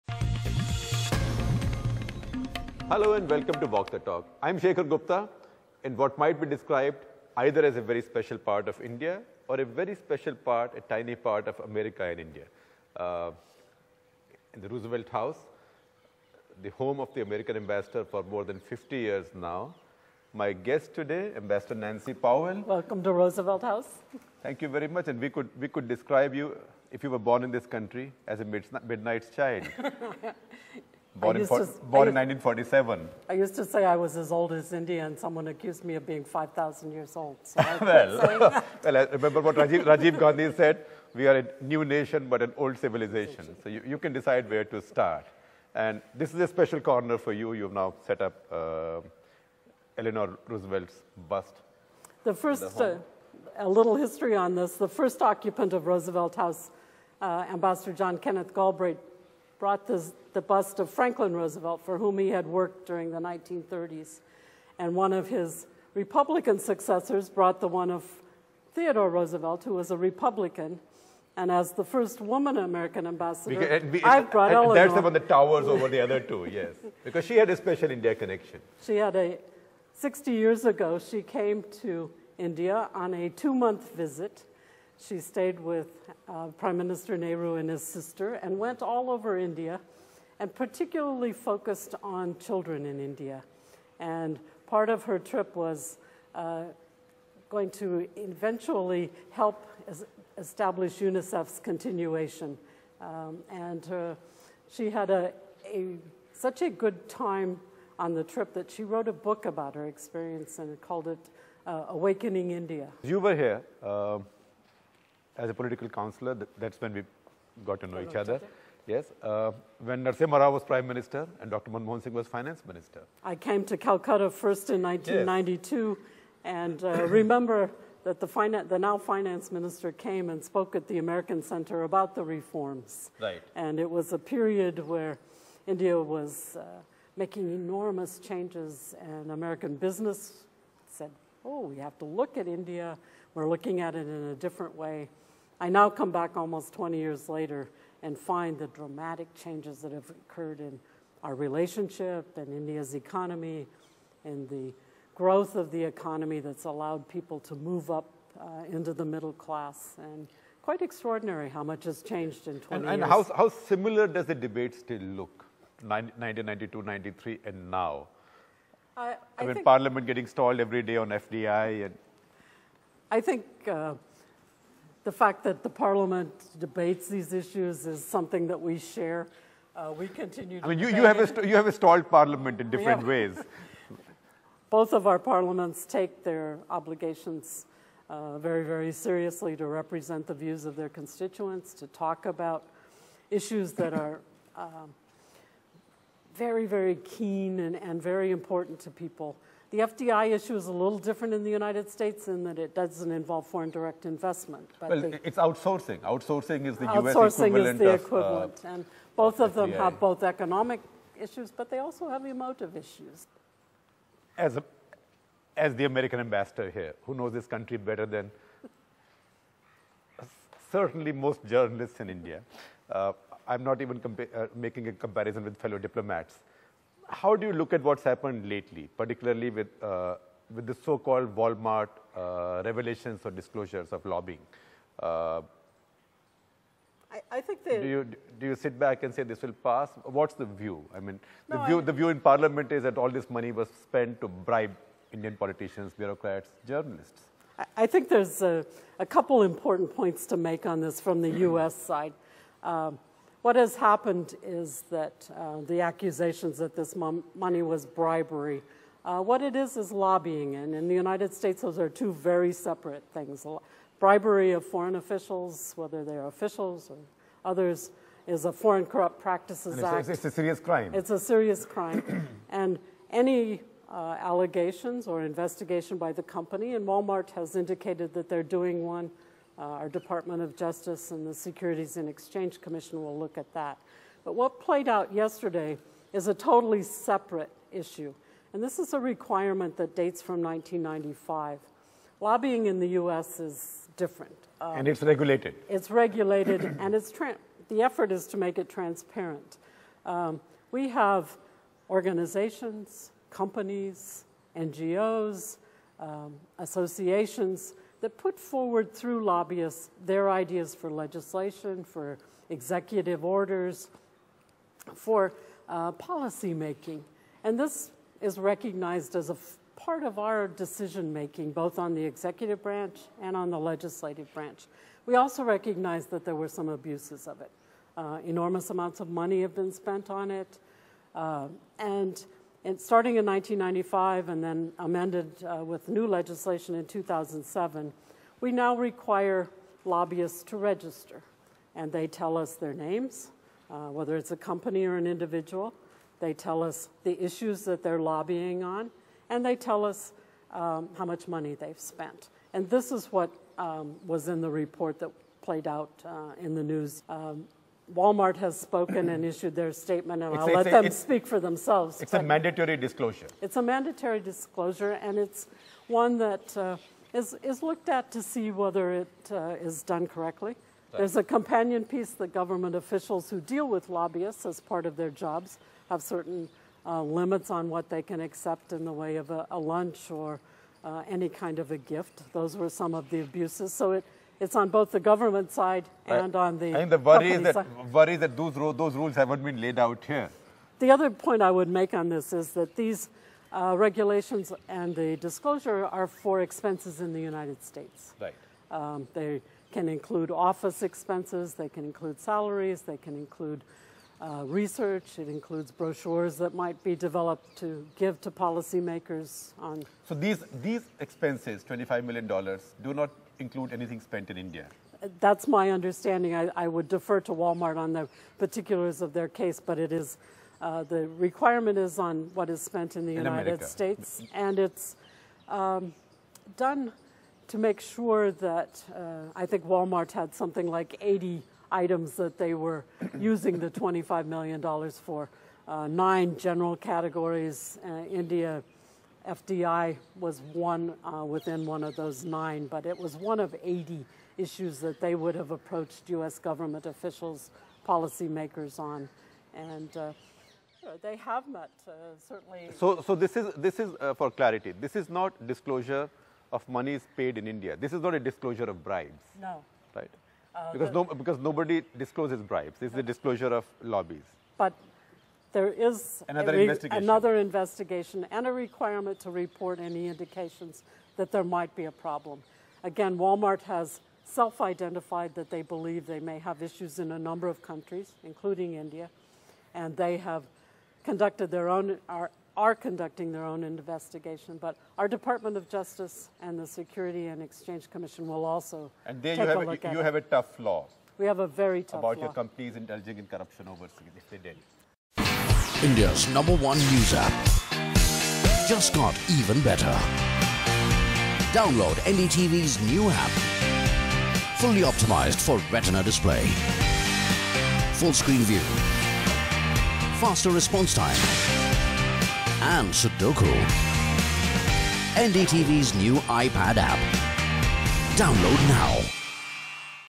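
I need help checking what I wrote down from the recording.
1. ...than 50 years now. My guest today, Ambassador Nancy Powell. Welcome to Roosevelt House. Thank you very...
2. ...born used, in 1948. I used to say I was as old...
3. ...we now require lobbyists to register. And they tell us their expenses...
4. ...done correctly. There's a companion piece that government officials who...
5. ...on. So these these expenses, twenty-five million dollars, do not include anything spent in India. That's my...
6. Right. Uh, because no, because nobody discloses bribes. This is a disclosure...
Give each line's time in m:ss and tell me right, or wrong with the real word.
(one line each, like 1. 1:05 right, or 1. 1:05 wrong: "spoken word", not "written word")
1. 0:18 right
2. 0:31 wrong: "1947", not "1948"
3. 5:38 wrong: "names", not "expenses"
4. 6:09 right
5. 6:49 right
6. 7:39 right.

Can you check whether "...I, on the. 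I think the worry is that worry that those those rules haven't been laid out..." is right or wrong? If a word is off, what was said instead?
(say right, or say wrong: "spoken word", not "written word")
right.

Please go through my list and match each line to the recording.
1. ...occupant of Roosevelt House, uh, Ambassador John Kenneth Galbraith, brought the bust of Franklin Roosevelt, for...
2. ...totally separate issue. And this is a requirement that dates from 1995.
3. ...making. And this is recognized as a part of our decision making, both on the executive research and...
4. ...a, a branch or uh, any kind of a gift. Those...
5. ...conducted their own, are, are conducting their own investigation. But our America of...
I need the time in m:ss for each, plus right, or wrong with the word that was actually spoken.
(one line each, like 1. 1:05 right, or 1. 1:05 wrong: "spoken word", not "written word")
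1. 0:55 right
2. 4:46 right
3. 5:16 wrong: "branch", not "research"
4. 6:19 wrong: "lunch", not "branch"
5. 8:01 wrong: "Department", not "America".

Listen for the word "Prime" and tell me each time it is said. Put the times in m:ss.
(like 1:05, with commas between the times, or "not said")
1:26, 2:00.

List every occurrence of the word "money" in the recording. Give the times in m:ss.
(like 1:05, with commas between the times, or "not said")
4:03, 4:16, 5:29, 5:51.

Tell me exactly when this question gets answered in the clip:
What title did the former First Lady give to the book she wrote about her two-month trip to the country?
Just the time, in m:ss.
1:51.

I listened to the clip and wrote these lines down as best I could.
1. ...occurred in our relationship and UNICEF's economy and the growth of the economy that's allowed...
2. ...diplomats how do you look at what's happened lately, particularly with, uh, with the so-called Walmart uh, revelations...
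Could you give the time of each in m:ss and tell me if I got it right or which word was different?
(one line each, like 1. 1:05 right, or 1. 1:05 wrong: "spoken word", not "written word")
1. 2:30 wrong: "India", not "UNICEF"
2. 3:45 right.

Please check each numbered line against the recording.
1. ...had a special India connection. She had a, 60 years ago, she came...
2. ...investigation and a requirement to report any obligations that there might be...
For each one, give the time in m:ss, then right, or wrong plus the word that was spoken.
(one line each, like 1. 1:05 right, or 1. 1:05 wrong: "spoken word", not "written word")
1. 1:17 right
2. 7:47 wrong: "indications", not "obligations".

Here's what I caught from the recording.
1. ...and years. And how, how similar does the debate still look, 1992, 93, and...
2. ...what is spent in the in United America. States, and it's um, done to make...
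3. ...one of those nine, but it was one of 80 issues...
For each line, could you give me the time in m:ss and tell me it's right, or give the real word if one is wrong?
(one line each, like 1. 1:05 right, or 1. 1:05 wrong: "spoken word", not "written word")
1. 2:42 right
2. 7:02 right
3. 7:21 right.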